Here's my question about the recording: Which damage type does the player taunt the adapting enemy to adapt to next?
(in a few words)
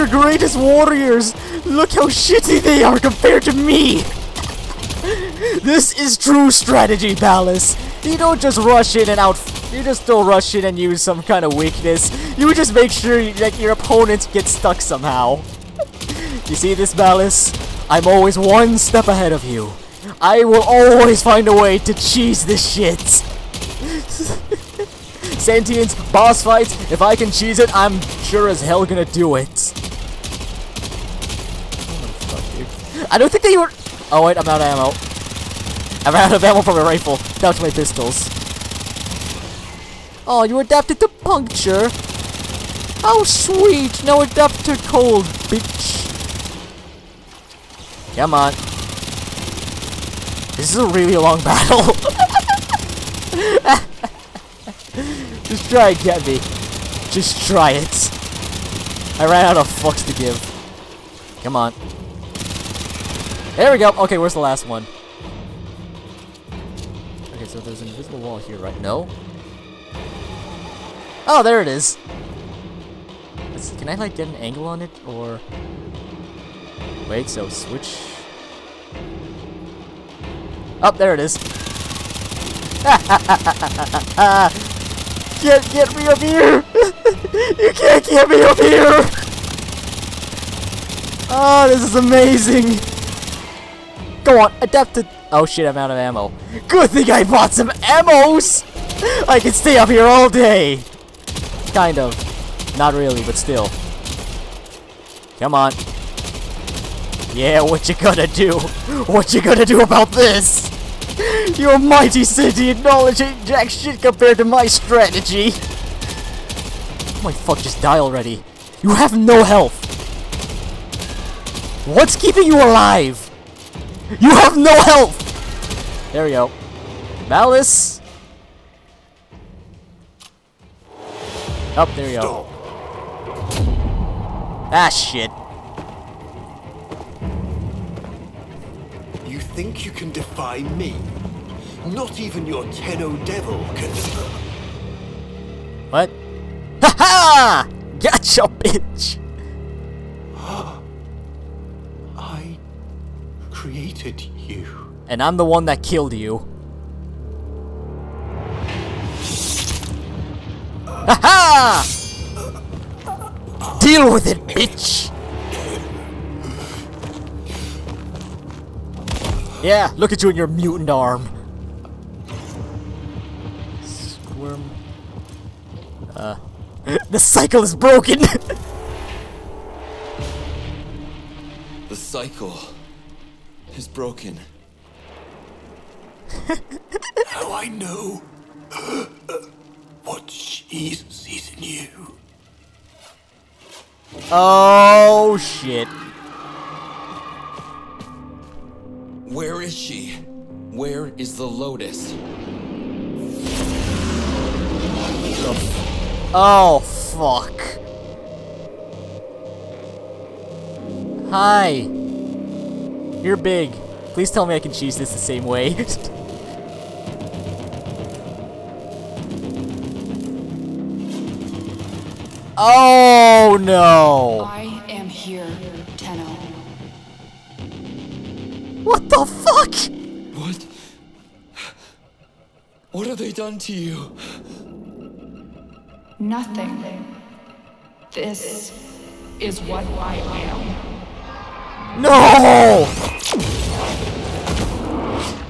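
cold.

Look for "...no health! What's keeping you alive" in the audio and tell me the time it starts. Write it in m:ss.
1:59.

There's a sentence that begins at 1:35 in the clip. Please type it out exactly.
Oh shit, I'm out of ammo.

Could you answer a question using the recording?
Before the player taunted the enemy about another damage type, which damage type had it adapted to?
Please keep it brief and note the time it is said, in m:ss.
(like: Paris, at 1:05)
puncture, at 0:41.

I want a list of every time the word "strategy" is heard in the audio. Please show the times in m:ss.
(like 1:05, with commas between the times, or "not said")
0:06, 1:54.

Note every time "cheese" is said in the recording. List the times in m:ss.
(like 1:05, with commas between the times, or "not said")
0:21, 0:27, 3:34.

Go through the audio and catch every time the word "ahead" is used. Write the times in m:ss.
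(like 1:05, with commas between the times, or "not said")
0:19.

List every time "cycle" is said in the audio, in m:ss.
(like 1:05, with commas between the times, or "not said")
2:57, 3:01.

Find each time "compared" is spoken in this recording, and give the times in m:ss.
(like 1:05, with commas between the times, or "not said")
0:02, 1:53.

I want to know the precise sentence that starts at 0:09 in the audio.
You just don't rush in and use some kind of weakness.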